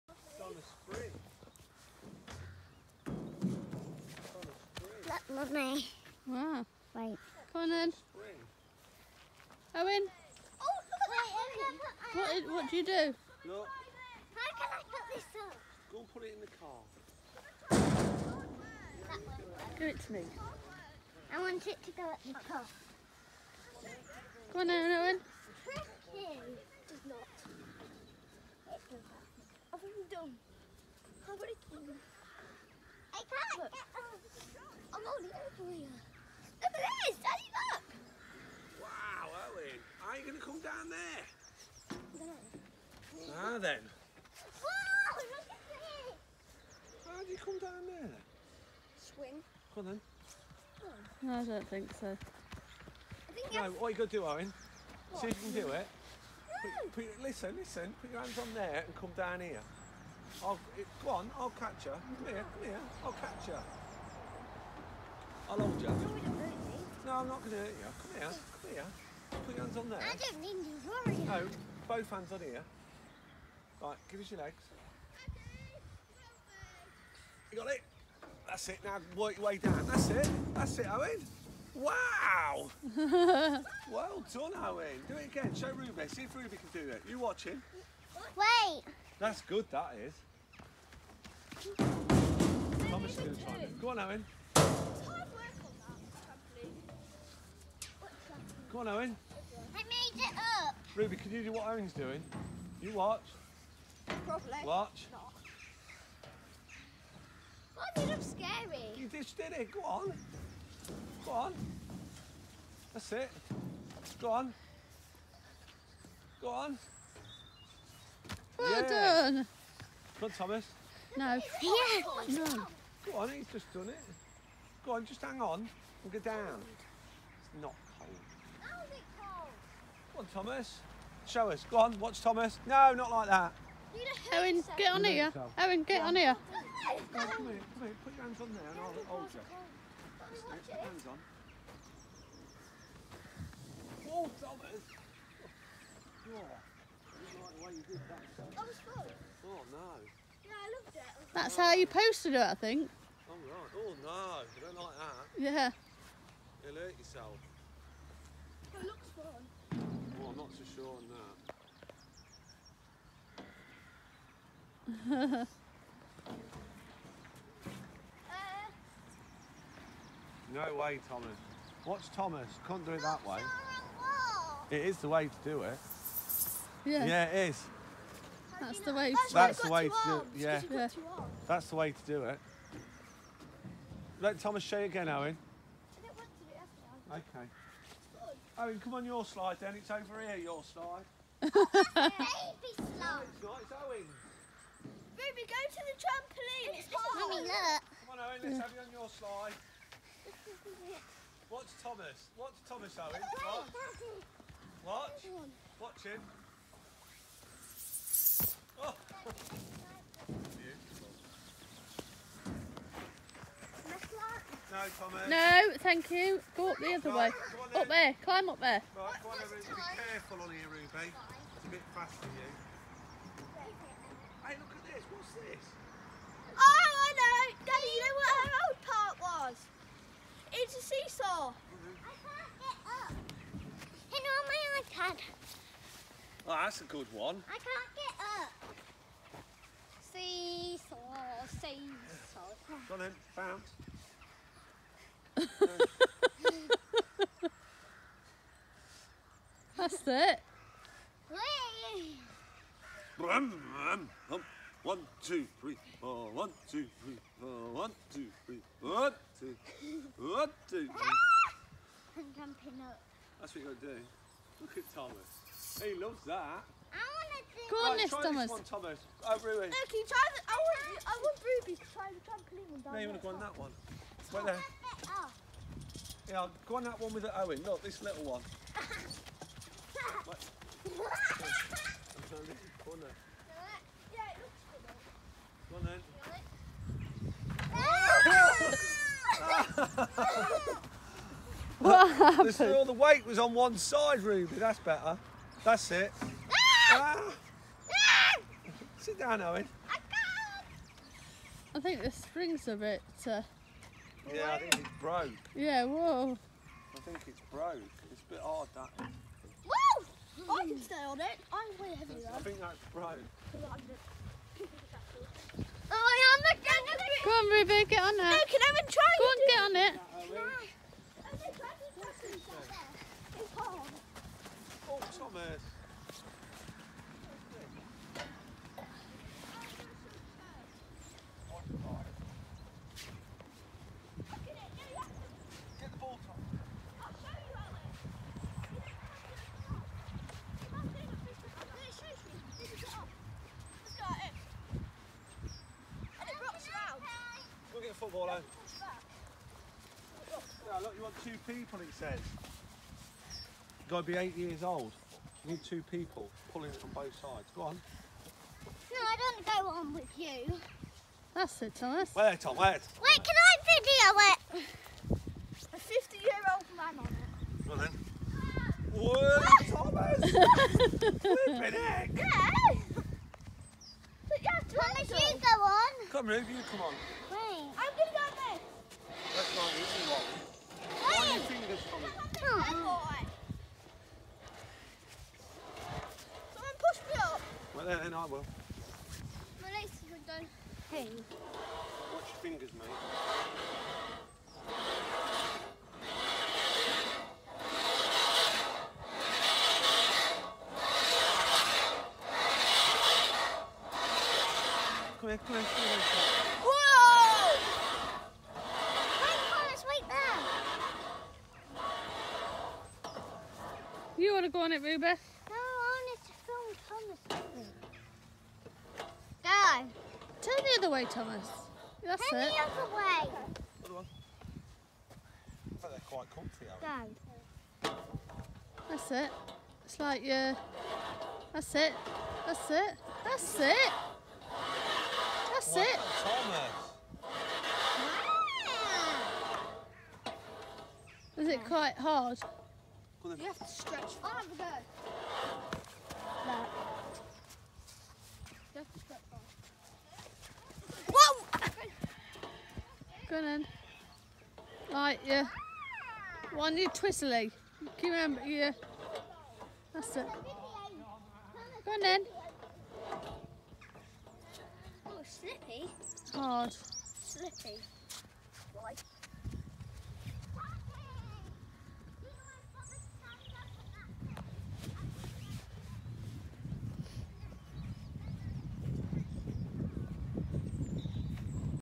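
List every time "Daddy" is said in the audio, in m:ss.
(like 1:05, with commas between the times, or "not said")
0:37, 3:47.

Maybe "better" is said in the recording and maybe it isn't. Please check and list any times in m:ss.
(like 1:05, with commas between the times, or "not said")
4:54.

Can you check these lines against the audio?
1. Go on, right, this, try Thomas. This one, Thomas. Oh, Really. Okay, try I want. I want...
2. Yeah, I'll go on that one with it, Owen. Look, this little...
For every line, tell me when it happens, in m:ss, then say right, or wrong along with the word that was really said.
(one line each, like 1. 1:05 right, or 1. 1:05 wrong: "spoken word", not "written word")
1. 4:27 right
2. 4:36 right.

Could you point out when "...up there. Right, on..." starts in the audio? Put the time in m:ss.
3:38.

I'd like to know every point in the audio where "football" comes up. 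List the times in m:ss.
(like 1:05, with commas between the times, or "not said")
5:48.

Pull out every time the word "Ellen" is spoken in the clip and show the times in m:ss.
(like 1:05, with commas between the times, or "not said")
0:39.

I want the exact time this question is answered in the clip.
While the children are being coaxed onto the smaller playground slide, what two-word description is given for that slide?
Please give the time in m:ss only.
3:11.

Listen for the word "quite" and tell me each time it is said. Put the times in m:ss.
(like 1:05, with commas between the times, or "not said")
7:06, 7:21.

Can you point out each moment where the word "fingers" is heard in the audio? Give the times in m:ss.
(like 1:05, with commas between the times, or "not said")
6:21, 6:32.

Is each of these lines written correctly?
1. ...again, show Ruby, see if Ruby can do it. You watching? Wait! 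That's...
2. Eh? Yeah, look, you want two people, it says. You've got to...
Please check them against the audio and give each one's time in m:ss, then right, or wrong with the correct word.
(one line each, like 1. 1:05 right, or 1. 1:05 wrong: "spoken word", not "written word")
1. 1:25 right
2. 5:48 right.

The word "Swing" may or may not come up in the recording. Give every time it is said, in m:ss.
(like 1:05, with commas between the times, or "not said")
0:48.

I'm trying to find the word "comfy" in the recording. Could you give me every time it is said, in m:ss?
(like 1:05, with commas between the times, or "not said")
7:06.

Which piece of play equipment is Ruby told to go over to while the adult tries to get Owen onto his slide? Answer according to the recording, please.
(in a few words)
trampoline.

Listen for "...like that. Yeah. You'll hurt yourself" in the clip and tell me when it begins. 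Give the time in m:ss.
2:34.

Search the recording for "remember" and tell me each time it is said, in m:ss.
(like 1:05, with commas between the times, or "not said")
7:38.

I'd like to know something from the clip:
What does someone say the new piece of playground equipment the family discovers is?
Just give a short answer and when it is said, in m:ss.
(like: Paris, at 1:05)
seesaw, at 3:50.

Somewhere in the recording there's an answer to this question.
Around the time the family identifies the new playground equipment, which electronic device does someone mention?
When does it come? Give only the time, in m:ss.
3:54.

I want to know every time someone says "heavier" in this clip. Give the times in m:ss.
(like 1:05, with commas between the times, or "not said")
5:11.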